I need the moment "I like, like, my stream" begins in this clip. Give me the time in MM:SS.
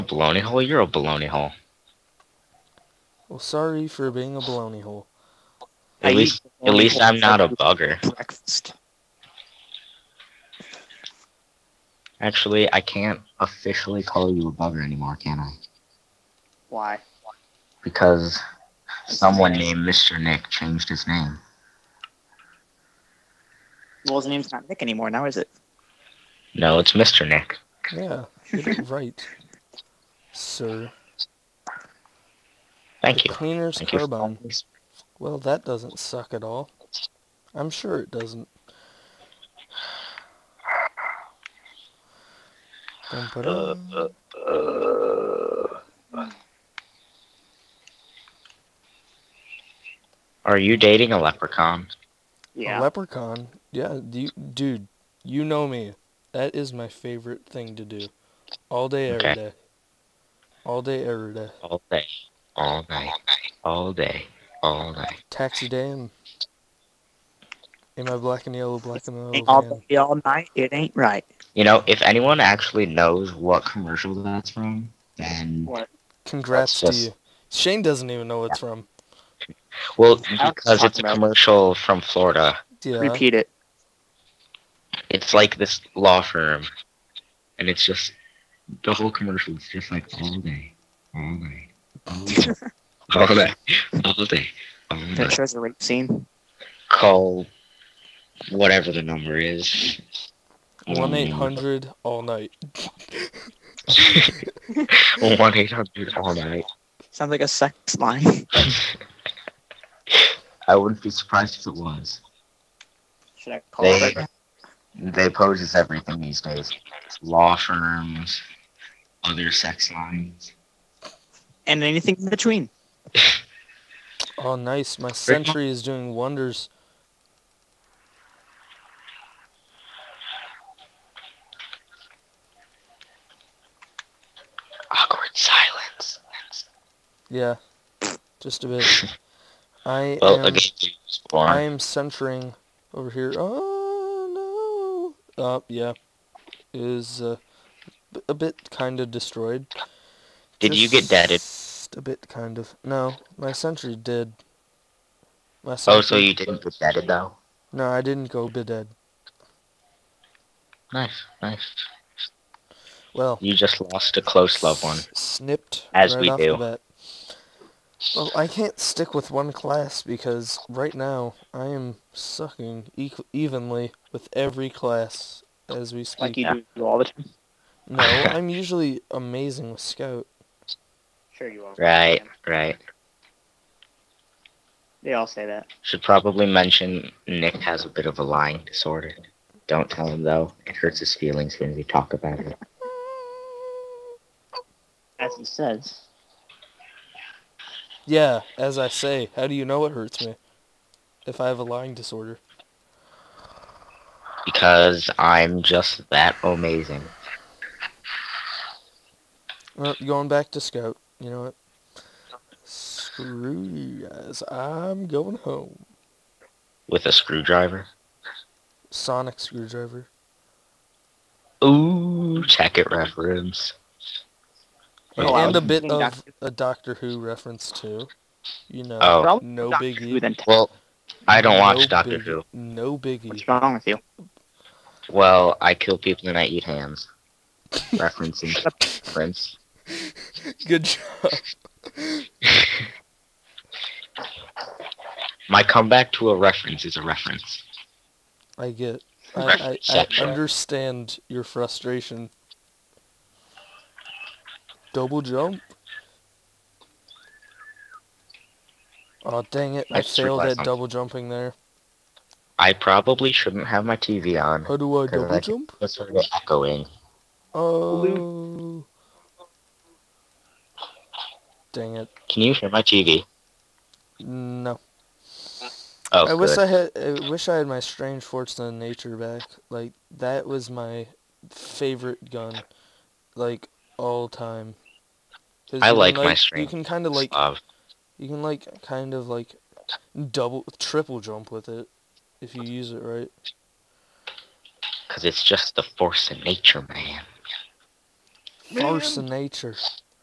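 04:45.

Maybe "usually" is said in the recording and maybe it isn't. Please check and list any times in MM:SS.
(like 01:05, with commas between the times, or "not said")
02:58.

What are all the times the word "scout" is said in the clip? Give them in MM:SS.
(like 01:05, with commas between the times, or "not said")
02:59, 03:30.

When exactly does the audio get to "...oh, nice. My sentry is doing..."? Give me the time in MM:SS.
02:04.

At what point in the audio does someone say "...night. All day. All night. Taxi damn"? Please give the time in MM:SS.
01:02.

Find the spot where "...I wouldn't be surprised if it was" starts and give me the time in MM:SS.
01:50.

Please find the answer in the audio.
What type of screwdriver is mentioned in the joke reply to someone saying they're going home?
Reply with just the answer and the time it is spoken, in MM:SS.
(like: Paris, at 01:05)
Sonic screwdriver, at 03:38.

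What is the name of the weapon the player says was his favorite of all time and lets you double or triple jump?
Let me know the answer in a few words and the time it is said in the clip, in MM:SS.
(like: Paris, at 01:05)
Force-A-Nature, at 04:38.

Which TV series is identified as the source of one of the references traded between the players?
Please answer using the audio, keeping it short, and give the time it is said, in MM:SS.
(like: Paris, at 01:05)
Doctor Who, at 03:46.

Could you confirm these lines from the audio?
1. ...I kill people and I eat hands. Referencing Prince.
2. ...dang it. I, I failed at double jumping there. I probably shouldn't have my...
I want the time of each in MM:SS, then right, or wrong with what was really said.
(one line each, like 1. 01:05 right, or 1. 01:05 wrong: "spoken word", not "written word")
1. 03:55 right
2. 04:19 right.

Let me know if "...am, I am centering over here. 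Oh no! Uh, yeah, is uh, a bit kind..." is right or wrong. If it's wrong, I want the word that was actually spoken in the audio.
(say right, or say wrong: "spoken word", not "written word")
right.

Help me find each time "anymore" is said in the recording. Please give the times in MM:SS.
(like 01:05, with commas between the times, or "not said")
00:14, 00:24.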